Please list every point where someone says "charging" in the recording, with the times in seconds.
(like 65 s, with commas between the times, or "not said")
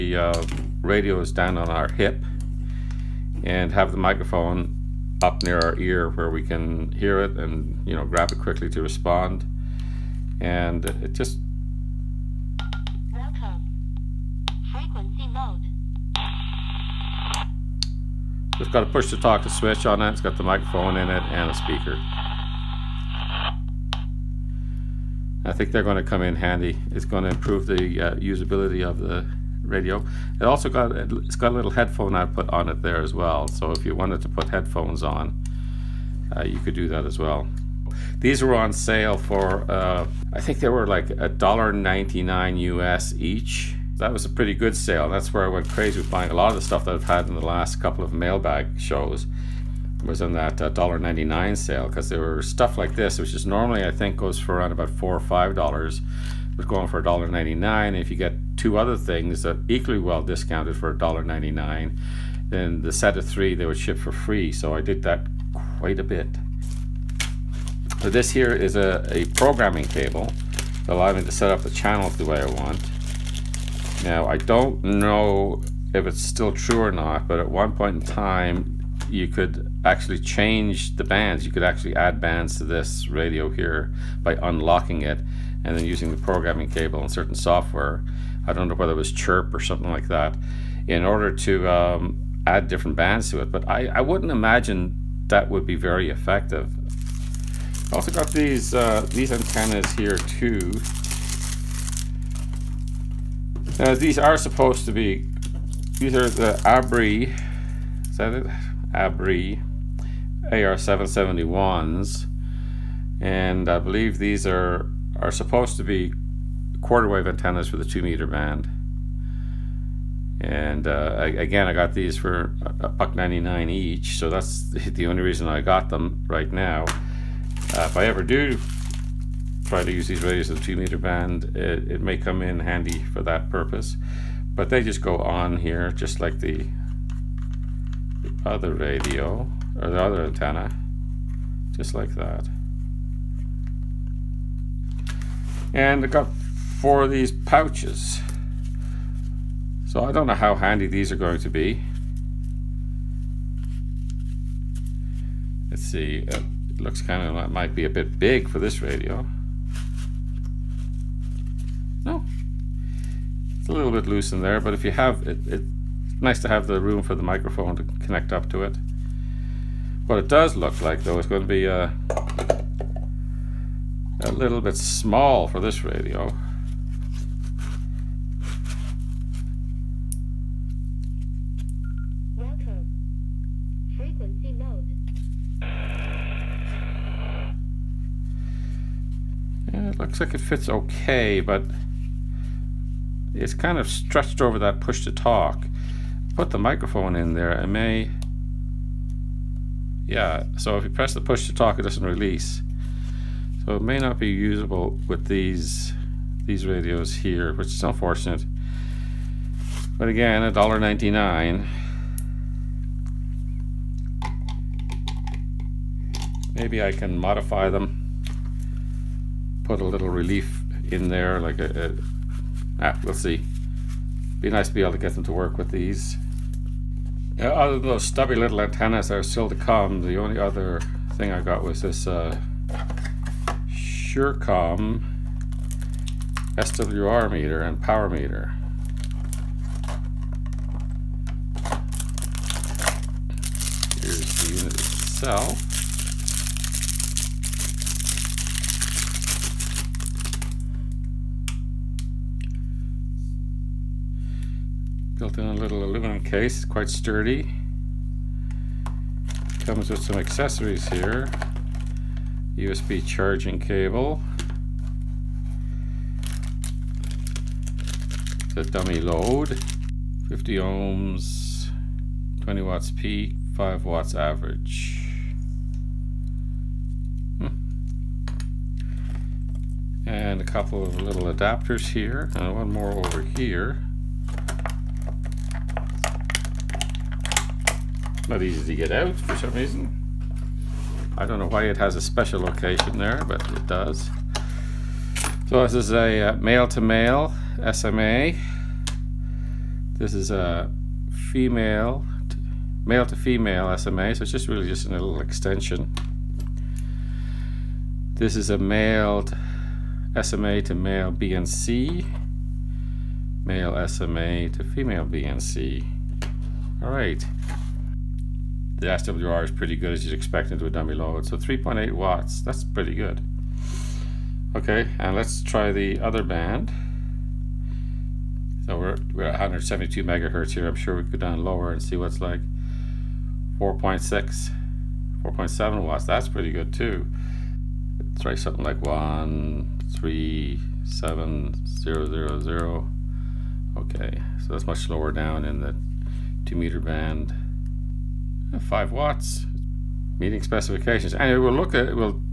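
263 s.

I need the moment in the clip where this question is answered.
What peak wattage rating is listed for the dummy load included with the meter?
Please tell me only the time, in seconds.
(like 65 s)
272 s.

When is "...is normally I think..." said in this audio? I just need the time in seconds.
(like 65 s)
53 s.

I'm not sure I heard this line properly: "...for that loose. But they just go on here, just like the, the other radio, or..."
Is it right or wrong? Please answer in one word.
wrong.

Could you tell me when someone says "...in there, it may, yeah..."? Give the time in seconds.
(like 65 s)
197 s.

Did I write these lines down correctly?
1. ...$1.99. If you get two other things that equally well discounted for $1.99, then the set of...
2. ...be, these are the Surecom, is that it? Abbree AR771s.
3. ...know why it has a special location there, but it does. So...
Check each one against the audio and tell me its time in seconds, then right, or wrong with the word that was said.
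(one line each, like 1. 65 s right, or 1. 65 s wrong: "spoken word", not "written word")
1. 57 s right
2. 104 s wrong: "Abbree", not "Surecom"
3. 291 s right.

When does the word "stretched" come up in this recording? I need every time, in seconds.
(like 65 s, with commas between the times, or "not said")
193 s.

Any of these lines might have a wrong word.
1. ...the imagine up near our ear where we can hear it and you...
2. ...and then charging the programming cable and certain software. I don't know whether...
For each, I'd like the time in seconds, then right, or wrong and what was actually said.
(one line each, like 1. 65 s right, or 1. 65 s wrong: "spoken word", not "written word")
1. 3 s wrong: "microphone", not "imagine"
2. 85 s wrong: "using", not "charging".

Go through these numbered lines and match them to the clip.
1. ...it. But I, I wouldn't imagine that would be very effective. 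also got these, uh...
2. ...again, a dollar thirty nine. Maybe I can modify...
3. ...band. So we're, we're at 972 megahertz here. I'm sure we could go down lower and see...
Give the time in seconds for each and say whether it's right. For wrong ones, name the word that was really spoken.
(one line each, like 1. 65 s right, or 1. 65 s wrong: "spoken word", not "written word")
1. 93 s right
2. 210 s wrong: "ninety", not "thirty"
3. 326 s wrong: "172", not "972".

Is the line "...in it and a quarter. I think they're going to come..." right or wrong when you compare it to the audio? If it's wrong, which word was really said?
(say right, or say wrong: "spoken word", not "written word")
wrong: "speaker", not "quarter".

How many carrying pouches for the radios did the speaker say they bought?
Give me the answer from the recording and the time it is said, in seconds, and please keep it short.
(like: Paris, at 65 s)
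4, at 146 s.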